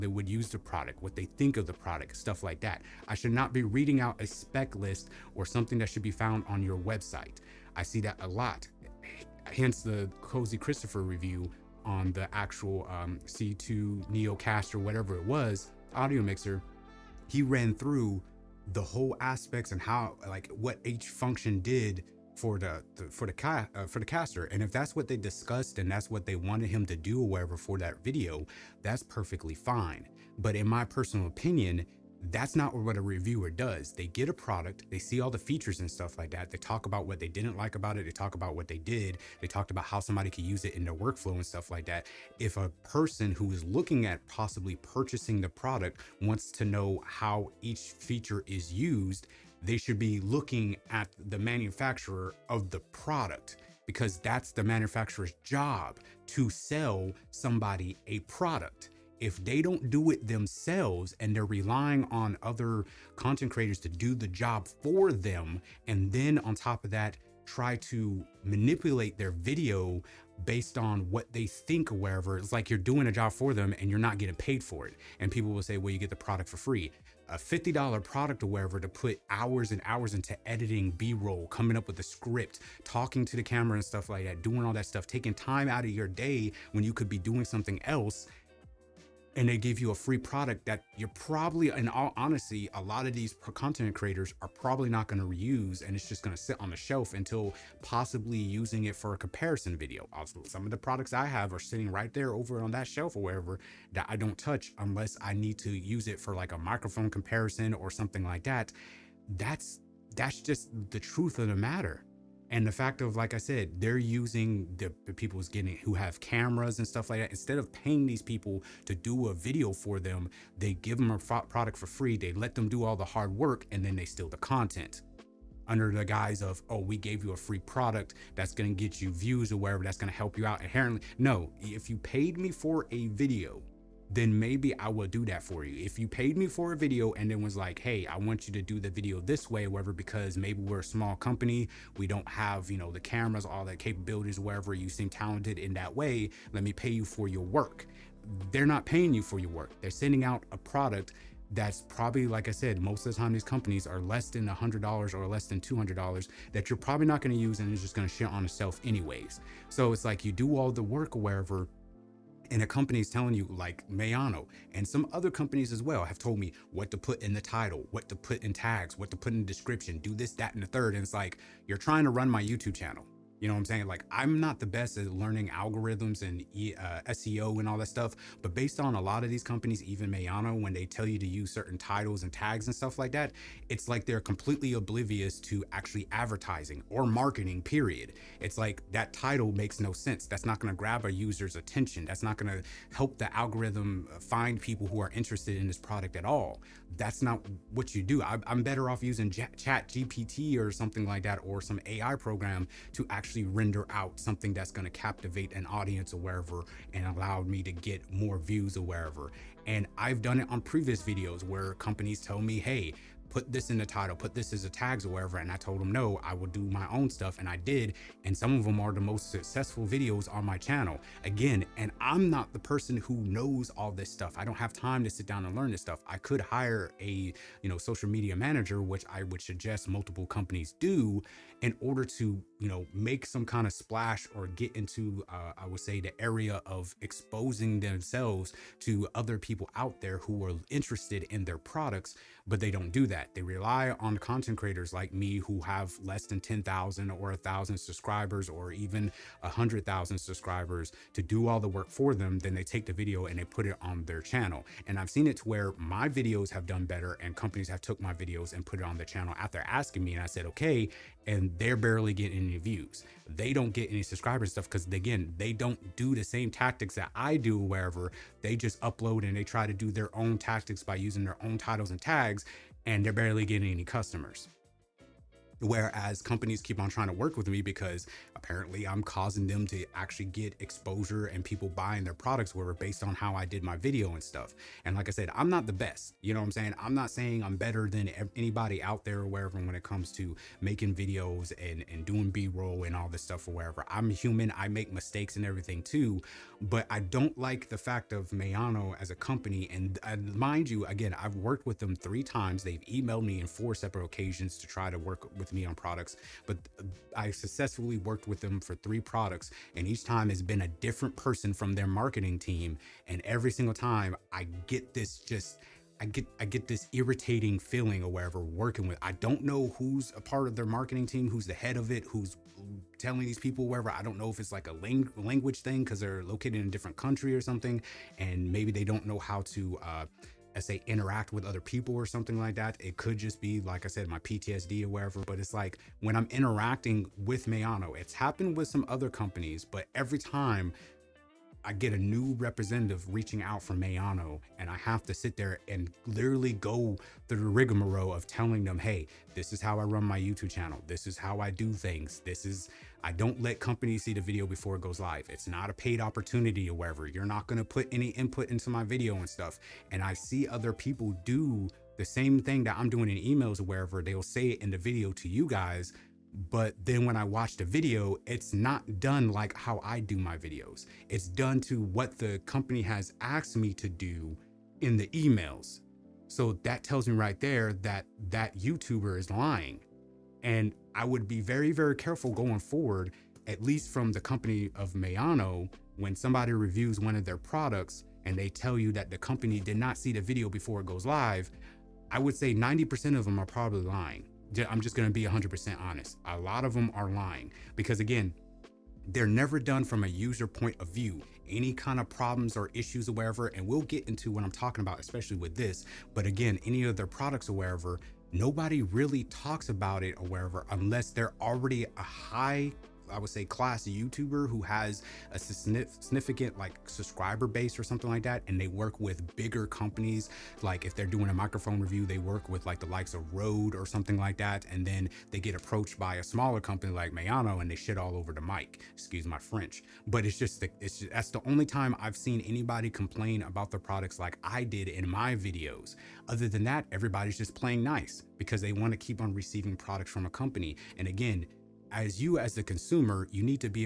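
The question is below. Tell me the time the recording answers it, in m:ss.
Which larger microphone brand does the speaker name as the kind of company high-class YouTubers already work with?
7:03.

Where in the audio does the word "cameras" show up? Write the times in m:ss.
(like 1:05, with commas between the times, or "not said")
1:23, 1:56, 2:22.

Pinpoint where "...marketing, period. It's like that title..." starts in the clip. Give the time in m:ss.
3:07.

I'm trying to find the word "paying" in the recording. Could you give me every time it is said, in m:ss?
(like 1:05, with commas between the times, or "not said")
1:57, 2:28.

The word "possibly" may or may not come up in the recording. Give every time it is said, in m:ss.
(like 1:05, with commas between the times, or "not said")
0:44, 1:37.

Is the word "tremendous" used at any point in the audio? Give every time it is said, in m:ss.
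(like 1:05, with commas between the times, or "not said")
not said.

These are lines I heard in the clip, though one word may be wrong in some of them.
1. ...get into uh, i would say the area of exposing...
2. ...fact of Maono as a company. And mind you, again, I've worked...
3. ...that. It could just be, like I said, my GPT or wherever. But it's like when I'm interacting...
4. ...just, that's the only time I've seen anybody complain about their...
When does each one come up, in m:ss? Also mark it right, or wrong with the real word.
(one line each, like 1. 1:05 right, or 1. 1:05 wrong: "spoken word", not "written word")
1. 3:54 right
2. 4:57 right
3. 5:32 wrong: "PTSD", not "GPT"
4. 7:10 right.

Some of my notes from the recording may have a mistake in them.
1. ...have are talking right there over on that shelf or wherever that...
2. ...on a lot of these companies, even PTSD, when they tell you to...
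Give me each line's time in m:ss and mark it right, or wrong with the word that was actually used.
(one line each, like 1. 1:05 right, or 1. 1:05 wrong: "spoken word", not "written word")
1. 1:41 wrong: "sitting", not "talking"
2. 2:58 wrong: "Maono", not "PTSD".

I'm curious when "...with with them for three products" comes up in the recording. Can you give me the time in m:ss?
5:08.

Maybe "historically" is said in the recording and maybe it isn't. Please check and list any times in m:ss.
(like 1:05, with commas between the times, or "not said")
not said.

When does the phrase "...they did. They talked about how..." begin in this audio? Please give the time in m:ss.
0:38.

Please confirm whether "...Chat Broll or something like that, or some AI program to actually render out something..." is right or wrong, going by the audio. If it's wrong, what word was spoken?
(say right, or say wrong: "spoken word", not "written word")
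wrong: "GPT", not "Broll".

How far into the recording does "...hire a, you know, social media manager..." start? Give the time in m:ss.
3:46.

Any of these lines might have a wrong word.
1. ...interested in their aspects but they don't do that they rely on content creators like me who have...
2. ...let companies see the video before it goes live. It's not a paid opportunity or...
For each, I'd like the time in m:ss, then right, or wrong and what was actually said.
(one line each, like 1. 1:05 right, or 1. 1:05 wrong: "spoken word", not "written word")
1. 4:00 wrong: "products", not "aspects"
2. 5:53 right.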